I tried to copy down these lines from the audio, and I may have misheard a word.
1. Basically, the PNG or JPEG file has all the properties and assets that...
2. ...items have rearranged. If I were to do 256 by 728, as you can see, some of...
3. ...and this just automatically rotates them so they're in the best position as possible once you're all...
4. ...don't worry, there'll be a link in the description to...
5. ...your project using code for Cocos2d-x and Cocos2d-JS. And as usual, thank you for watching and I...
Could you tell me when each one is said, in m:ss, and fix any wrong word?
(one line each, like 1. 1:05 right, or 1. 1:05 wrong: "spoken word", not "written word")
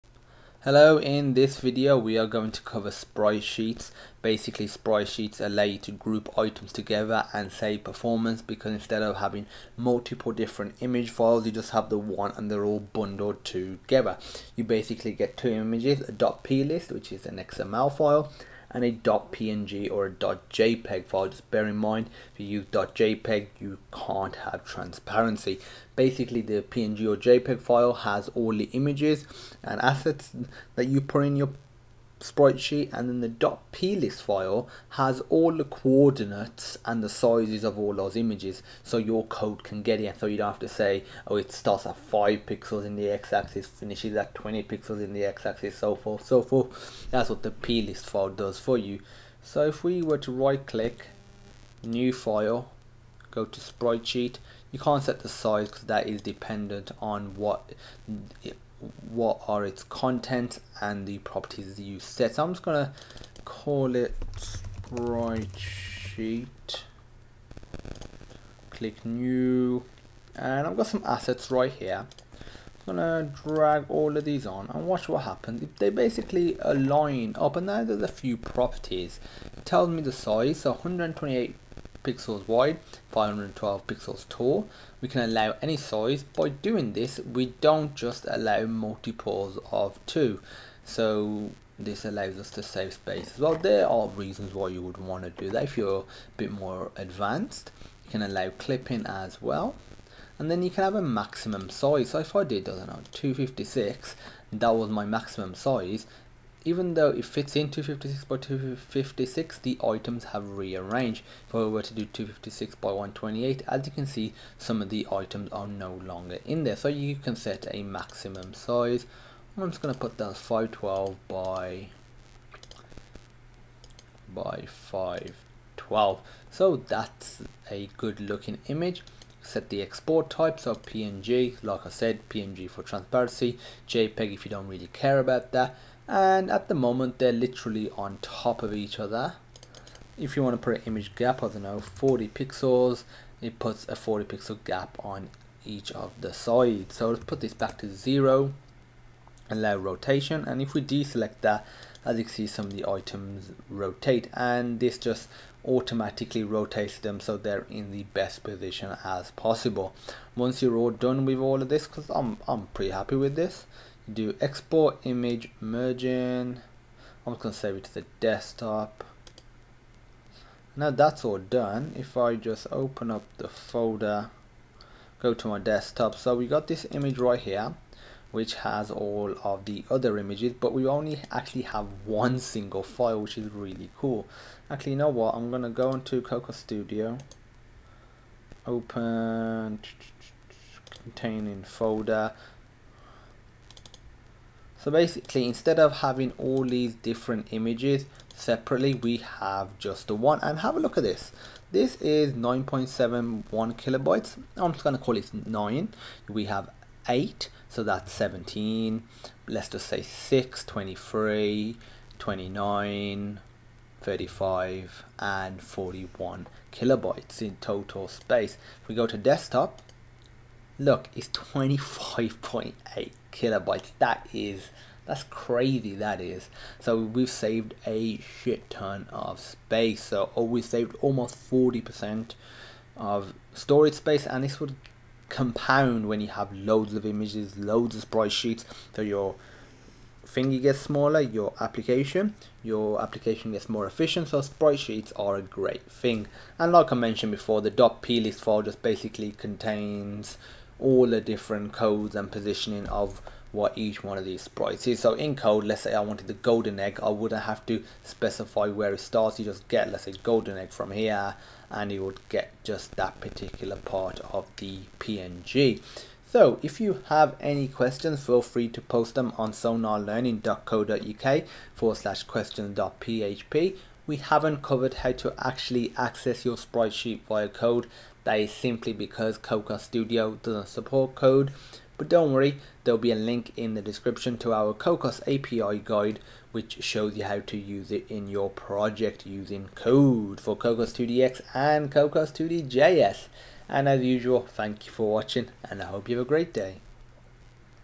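1. 0:25 wrong: "images", not "properties"
2. 1:49 wrong: "128", not "728"
3. 2:34 right
4. 4:42 right
5. 4:48 right.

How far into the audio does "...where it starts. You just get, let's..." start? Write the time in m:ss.
4:18.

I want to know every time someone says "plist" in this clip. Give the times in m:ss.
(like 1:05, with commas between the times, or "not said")
0:16, 0:33, 0:47, 4:07.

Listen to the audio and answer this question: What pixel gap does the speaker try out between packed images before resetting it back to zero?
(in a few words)
40 pixels.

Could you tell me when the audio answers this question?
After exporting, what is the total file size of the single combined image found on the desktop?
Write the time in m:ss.
3:41.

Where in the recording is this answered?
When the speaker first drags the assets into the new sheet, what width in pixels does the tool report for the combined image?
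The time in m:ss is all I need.
1:20.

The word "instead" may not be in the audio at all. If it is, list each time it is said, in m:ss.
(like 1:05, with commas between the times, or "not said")
0:08, 3:15.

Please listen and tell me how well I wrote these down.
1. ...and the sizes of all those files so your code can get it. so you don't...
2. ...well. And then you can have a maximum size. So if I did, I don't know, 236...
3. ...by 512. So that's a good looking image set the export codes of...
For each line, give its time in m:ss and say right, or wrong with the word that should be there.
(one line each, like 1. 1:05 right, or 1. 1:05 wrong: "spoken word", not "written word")
1. 0:36 wrong: "images", not "files"
2. 1:39 wrong: "256", not "236"
3. 2:04 wrong: "types", not "codes".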